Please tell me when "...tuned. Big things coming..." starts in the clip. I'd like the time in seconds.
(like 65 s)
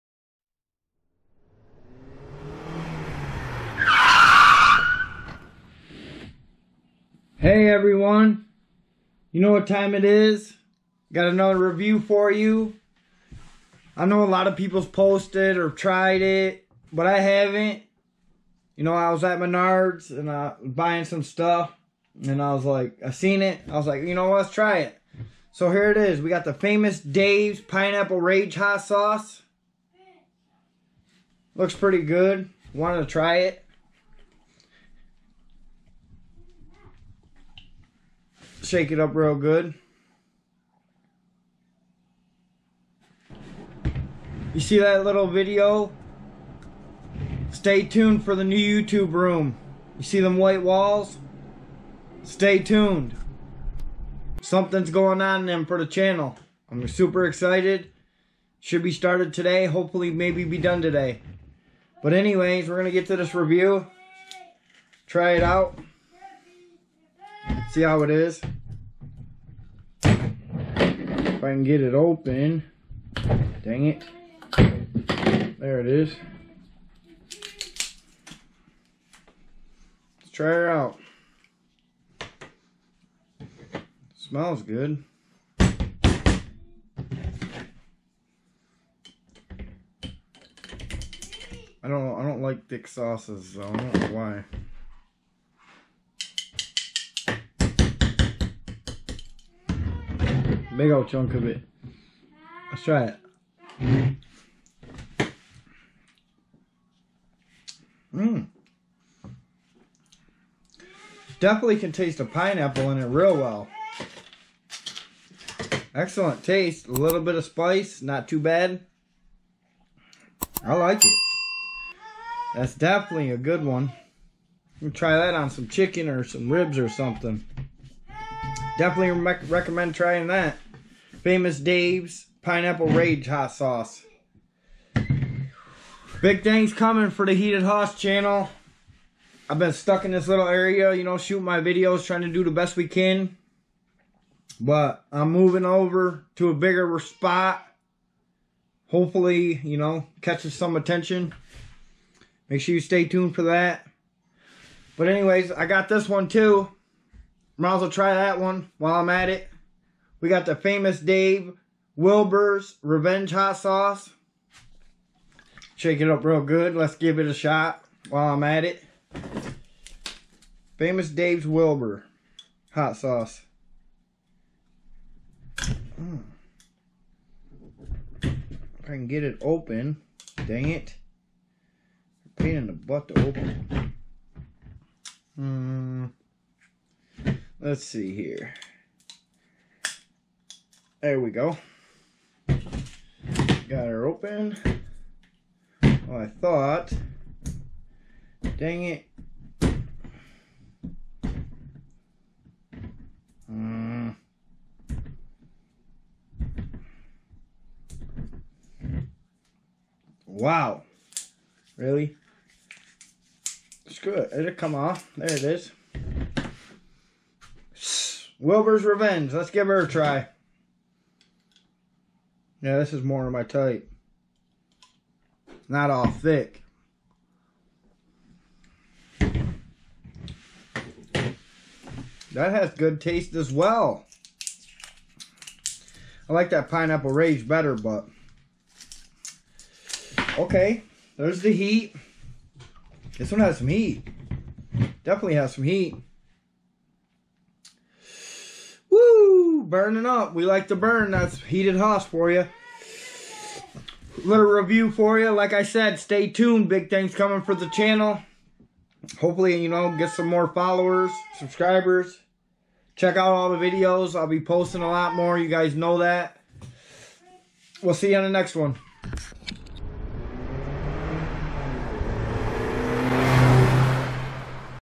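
256 s.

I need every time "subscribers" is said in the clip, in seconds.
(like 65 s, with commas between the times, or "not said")
261 s.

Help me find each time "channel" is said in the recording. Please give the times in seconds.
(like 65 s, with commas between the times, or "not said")
55 s, 137 s, 257 s.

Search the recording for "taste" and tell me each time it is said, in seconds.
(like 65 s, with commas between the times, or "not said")
111 s, 116 s, 233 s.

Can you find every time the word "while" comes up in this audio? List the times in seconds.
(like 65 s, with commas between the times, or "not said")
158 s, 168 s.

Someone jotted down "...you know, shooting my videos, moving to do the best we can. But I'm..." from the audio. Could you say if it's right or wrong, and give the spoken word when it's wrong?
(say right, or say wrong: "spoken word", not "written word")
wrong: "trying", not "moving".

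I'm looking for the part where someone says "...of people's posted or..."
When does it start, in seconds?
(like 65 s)
14 s.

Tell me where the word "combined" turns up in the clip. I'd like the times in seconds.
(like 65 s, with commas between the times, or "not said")
not said.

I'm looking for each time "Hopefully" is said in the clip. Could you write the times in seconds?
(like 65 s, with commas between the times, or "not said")
59 s, 148 s, 259 s.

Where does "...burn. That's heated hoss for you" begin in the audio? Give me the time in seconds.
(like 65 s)
250 s.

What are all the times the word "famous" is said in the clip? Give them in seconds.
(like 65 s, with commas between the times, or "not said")
26 s, 131 s, 160 s, 170 s.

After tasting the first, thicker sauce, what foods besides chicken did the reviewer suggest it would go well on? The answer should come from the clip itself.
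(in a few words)
Ribs.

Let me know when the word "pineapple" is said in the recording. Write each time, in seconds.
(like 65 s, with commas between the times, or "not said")
27 s, 112 s, 132 s, 236 s.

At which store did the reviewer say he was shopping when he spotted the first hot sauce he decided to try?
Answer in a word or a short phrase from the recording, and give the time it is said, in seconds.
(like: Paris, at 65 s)
Menards, at 19 s.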